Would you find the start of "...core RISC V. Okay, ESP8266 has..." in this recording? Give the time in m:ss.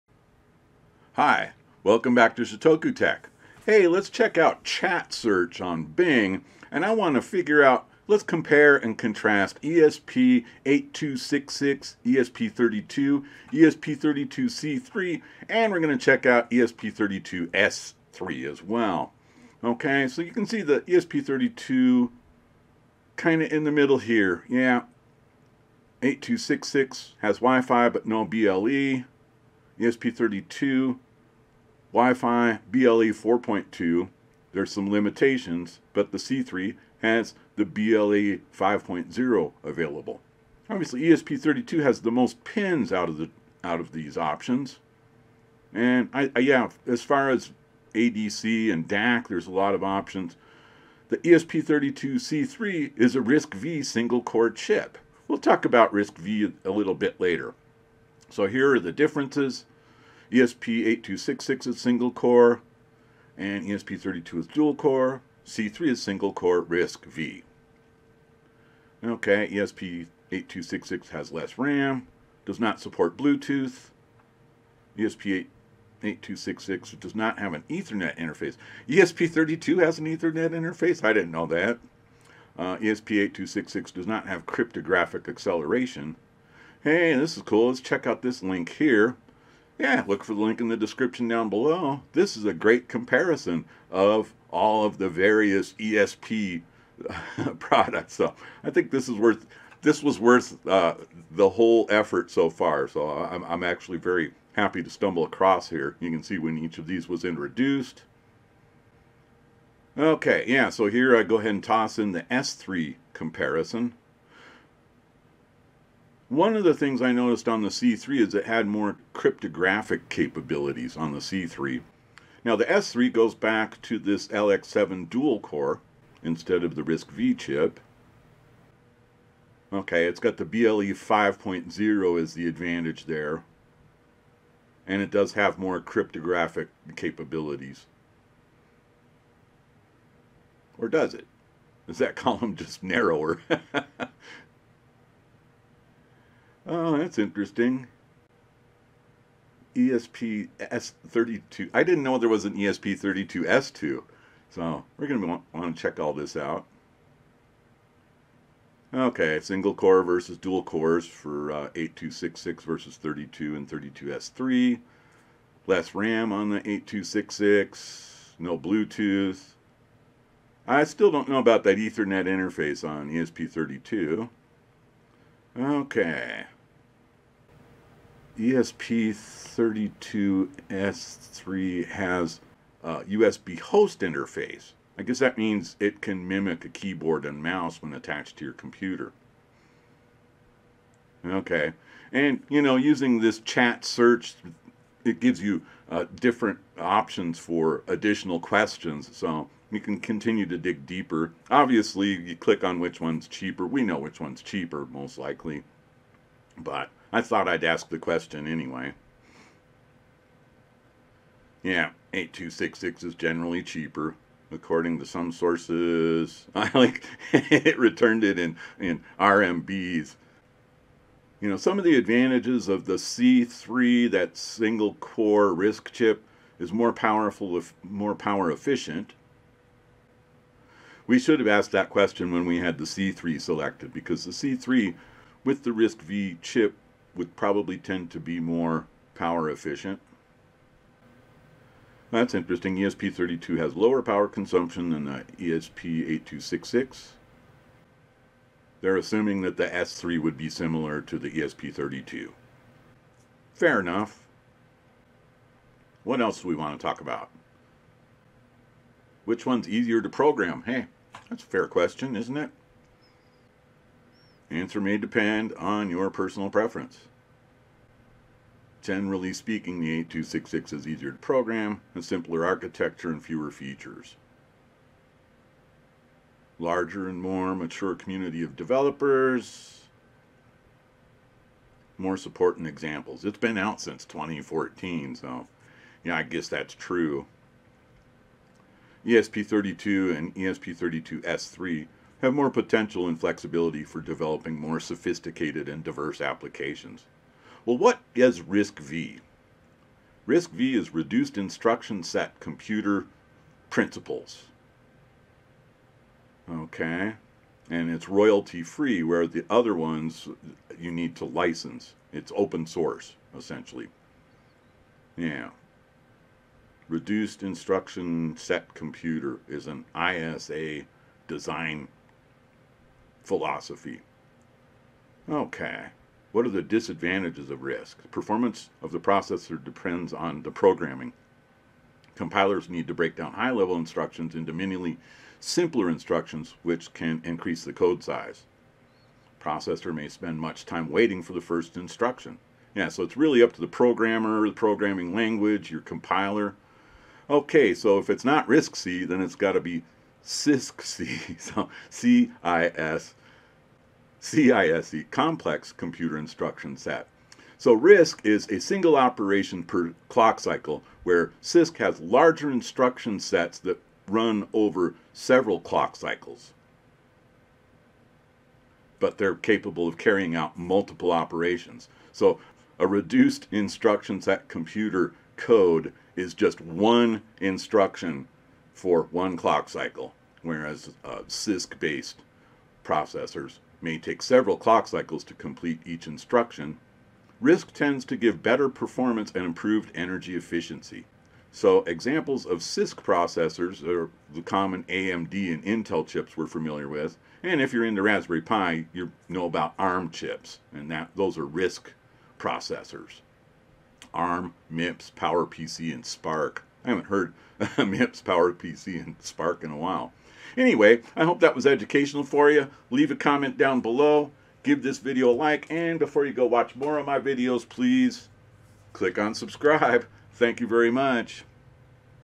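1:06.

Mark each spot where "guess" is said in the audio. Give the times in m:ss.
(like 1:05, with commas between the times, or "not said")
3:05, 4:46.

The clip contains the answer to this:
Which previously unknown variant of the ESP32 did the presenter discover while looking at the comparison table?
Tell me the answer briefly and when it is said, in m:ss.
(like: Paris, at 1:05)
ESP32 S2, at 2:32.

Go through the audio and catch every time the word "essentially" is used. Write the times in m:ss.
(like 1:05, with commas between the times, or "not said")
5:13.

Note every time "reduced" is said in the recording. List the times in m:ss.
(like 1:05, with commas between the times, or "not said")
5:00, 5:16, 6:12.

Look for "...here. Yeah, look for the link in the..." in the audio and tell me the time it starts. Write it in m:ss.
1:28.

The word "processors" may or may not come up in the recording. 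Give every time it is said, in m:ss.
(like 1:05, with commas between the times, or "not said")
5:28, 5:39, 6:22, 6:32, 6:42.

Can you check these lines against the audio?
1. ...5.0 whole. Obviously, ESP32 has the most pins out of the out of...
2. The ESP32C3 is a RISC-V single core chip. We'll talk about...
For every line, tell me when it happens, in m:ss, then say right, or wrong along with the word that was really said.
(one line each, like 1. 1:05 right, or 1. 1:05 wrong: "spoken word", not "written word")
1. 0:38 wrong: "available", not "whole"
2. 0:51 right.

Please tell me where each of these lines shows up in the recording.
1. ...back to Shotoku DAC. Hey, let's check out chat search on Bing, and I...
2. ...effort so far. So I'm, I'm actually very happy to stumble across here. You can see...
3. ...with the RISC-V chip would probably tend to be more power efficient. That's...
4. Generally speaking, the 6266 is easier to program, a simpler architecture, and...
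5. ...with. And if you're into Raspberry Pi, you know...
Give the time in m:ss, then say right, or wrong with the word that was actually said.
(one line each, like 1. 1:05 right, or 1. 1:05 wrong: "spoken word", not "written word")
1. 0:02 wrong: "Tech", not "DAC"
2. 1:41 right
3. 3:55 right
4. 4:28 wrong: "8266", not "6266"
5. 6:36 right.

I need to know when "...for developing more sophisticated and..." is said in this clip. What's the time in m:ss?
4:53.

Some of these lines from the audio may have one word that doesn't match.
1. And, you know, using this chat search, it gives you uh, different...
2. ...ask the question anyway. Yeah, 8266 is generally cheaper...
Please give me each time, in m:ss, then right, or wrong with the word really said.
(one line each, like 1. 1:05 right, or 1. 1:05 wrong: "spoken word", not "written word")
1. 3:12 right
2. 3:27 right.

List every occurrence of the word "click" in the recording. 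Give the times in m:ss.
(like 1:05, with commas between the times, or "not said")
3:22, 6:58.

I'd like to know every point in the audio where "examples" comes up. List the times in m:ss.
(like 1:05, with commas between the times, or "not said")
4:42, 6:31.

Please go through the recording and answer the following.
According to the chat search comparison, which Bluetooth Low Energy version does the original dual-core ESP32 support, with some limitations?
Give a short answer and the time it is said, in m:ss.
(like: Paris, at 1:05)
BLE 4.2, at 0:32.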